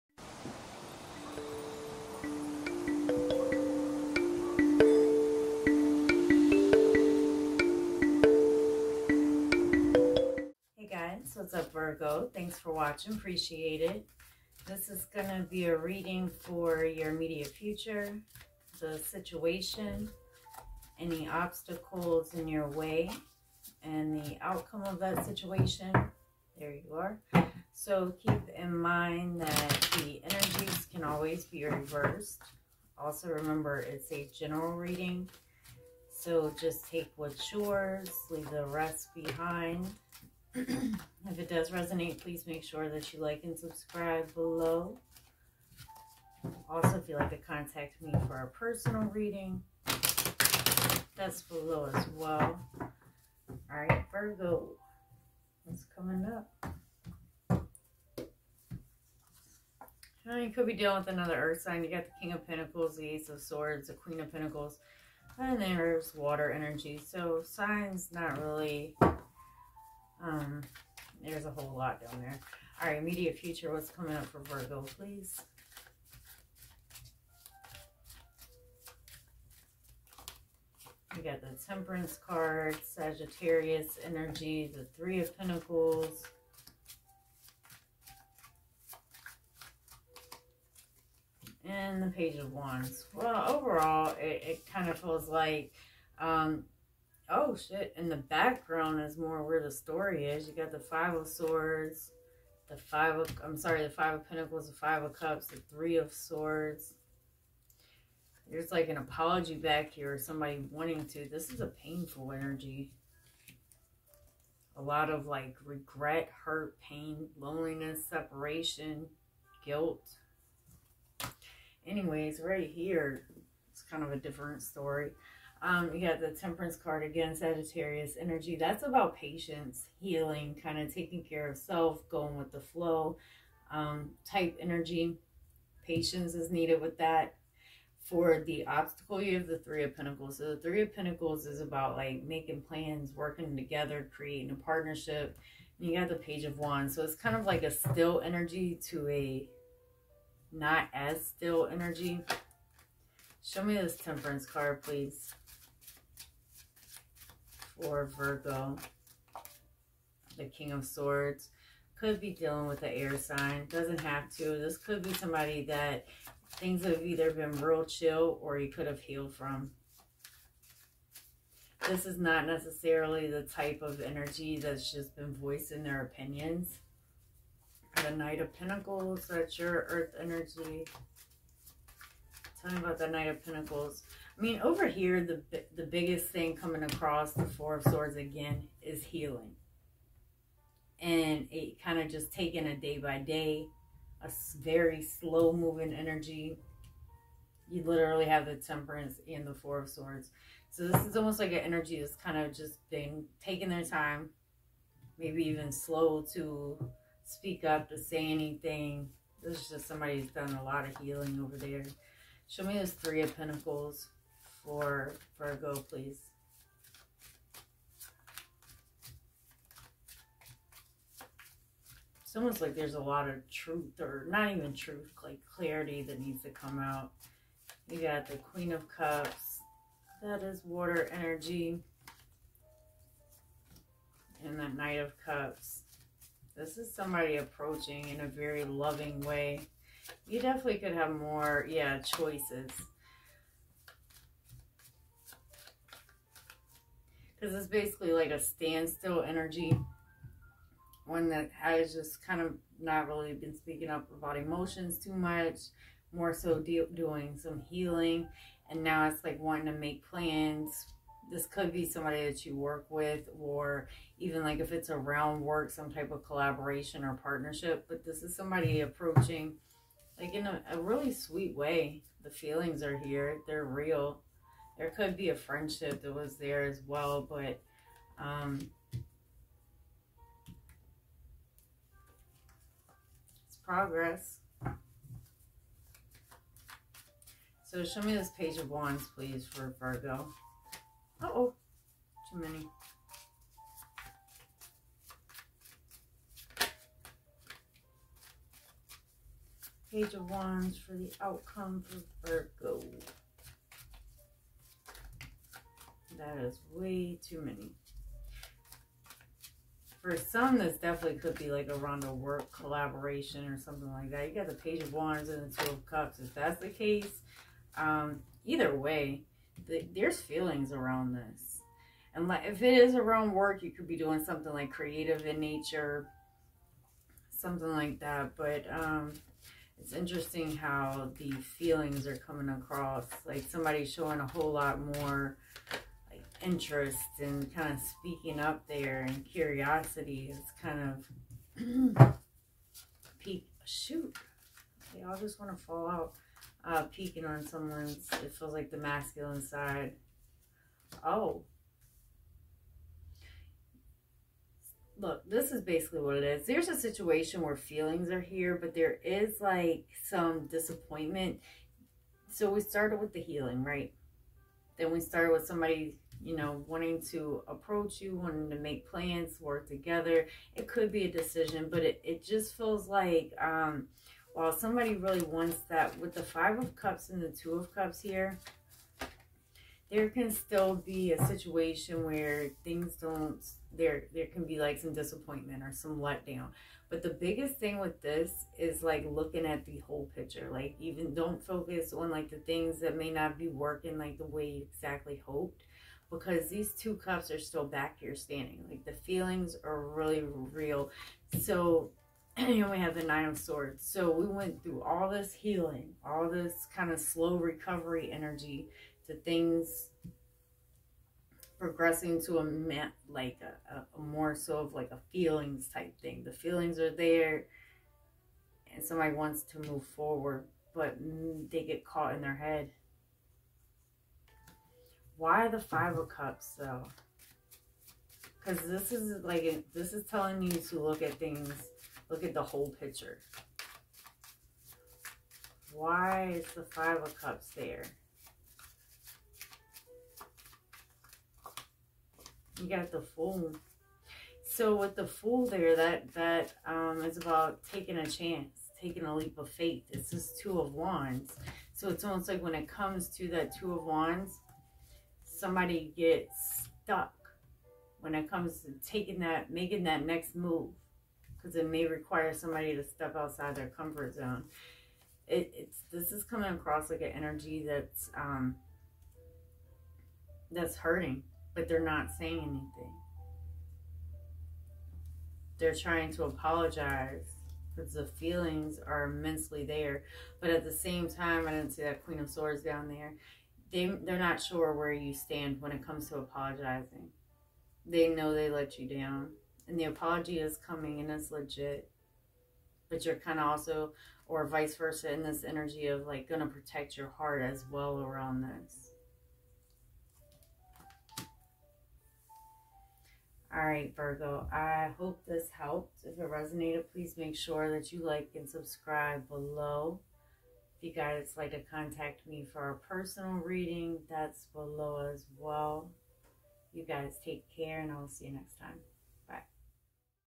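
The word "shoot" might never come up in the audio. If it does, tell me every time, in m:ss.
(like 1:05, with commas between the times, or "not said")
5:43.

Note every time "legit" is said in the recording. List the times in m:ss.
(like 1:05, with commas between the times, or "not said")
8:11.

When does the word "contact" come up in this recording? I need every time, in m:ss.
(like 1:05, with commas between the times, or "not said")
0:47, 8:31.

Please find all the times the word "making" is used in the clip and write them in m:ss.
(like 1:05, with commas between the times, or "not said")
2:22, 7:39.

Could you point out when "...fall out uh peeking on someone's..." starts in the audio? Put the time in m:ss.
5:45.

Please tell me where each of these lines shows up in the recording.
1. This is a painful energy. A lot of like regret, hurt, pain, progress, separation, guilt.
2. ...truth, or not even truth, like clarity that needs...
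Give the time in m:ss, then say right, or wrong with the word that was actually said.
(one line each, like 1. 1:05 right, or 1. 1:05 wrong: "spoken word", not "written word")
1. 1:51 wrong: "loneliness", not "progress"
2. 3:43 right.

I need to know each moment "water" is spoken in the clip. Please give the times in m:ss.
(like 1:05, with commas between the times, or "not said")
1:06, 3:50.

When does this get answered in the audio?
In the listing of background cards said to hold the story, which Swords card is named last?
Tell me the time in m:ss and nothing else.
1:45.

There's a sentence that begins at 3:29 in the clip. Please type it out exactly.
This is just somebody who's done a lot of healing over there.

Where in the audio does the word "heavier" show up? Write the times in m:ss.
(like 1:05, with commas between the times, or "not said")
not said.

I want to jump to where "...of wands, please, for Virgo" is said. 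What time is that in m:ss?
4:48.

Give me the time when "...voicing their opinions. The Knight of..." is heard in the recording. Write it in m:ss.
2:55.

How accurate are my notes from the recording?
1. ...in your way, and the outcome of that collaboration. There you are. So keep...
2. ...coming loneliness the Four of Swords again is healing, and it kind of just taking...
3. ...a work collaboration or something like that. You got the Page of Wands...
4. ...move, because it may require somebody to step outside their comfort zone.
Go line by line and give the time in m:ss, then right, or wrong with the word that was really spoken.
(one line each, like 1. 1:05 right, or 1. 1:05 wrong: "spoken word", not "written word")
1. 0:22 wrong: "situation", not "collaboration"
2. 3:06 wrong: "across", not "loneliness"
3. 5:12 right
4. 7:40 right.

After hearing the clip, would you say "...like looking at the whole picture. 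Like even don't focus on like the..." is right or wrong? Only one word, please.
right.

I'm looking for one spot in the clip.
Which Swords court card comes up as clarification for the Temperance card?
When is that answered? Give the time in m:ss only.
2:40.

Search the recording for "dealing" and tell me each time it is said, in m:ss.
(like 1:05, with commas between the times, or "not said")
1:00, 2:42.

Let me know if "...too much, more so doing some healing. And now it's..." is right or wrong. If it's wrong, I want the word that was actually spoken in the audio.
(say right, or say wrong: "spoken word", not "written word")
right.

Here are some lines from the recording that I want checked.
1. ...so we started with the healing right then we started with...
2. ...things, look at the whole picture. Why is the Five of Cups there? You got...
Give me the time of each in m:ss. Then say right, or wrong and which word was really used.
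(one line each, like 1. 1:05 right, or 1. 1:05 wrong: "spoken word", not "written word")
1. 6:02 right
2. 7:11 right.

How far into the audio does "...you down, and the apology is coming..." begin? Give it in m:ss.
8:08.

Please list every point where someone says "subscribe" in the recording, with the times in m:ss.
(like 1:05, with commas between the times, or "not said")
0:43, 8:28.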